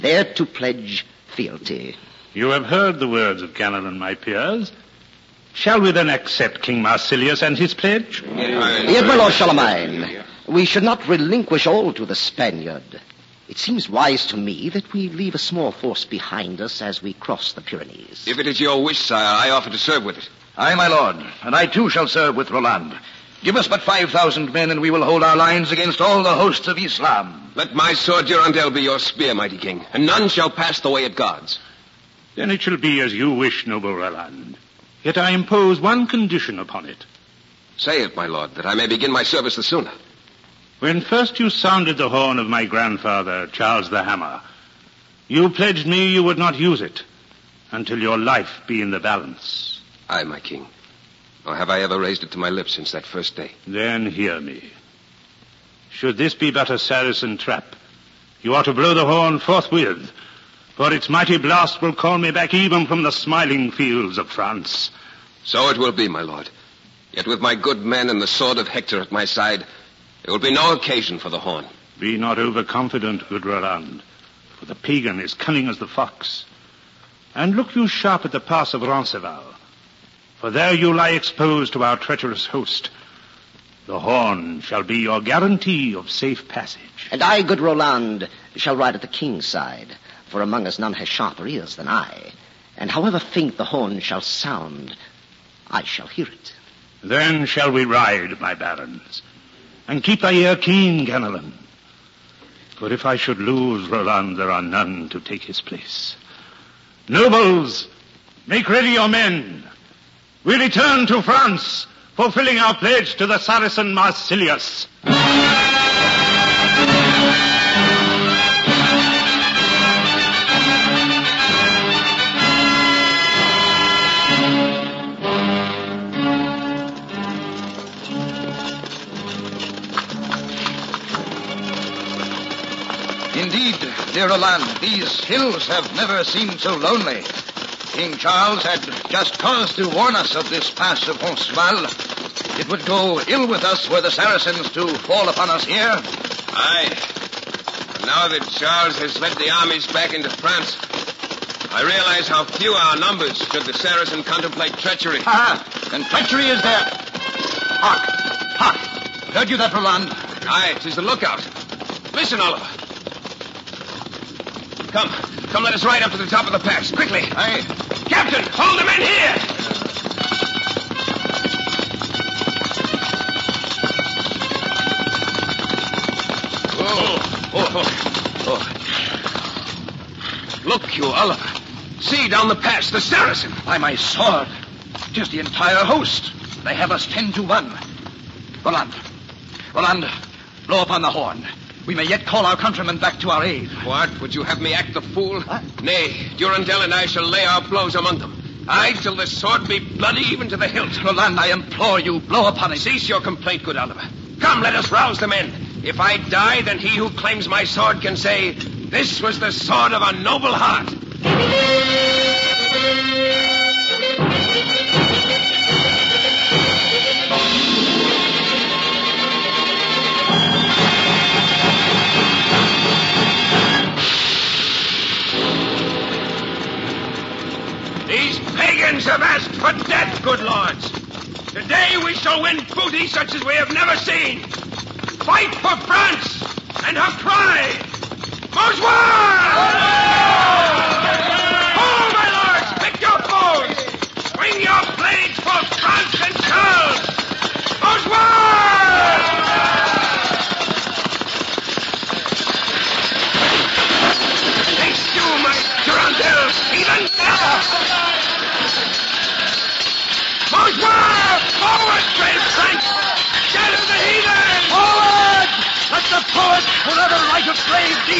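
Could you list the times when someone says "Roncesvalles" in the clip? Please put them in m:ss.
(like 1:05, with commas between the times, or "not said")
1:18, 2:21.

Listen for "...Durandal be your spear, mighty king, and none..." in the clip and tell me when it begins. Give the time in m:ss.
0:28.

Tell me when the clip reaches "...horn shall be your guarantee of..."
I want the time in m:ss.
1:23.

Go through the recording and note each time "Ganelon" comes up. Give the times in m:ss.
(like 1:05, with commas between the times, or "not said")
0:03, 1:41.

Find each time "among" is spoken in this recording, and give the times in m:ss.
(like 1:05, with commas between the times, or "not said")
1:30, 3:17.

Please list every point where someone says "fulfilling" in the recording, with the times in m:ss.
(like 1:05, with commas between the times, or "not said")
1:52.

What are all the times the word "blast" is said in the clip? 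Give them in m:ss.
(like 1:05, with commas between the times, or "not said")
1:01.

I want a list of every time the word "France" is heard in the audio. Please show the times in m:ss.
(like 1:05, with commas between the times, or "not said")
1:04, 1:51, 2:30, 3:55.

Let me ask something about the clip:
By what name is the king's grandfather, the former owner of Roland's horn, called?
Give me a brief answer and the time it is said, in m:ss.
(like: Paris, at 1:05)
Charles the Hammer, at 0:43.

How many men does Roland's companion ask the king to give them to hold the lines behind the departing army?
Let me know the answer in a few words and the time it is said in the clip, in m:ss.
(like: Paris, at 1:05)
5,000, at 0:23.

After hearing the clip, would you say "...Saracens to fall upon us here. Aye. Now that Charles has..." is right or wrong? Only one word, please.
right.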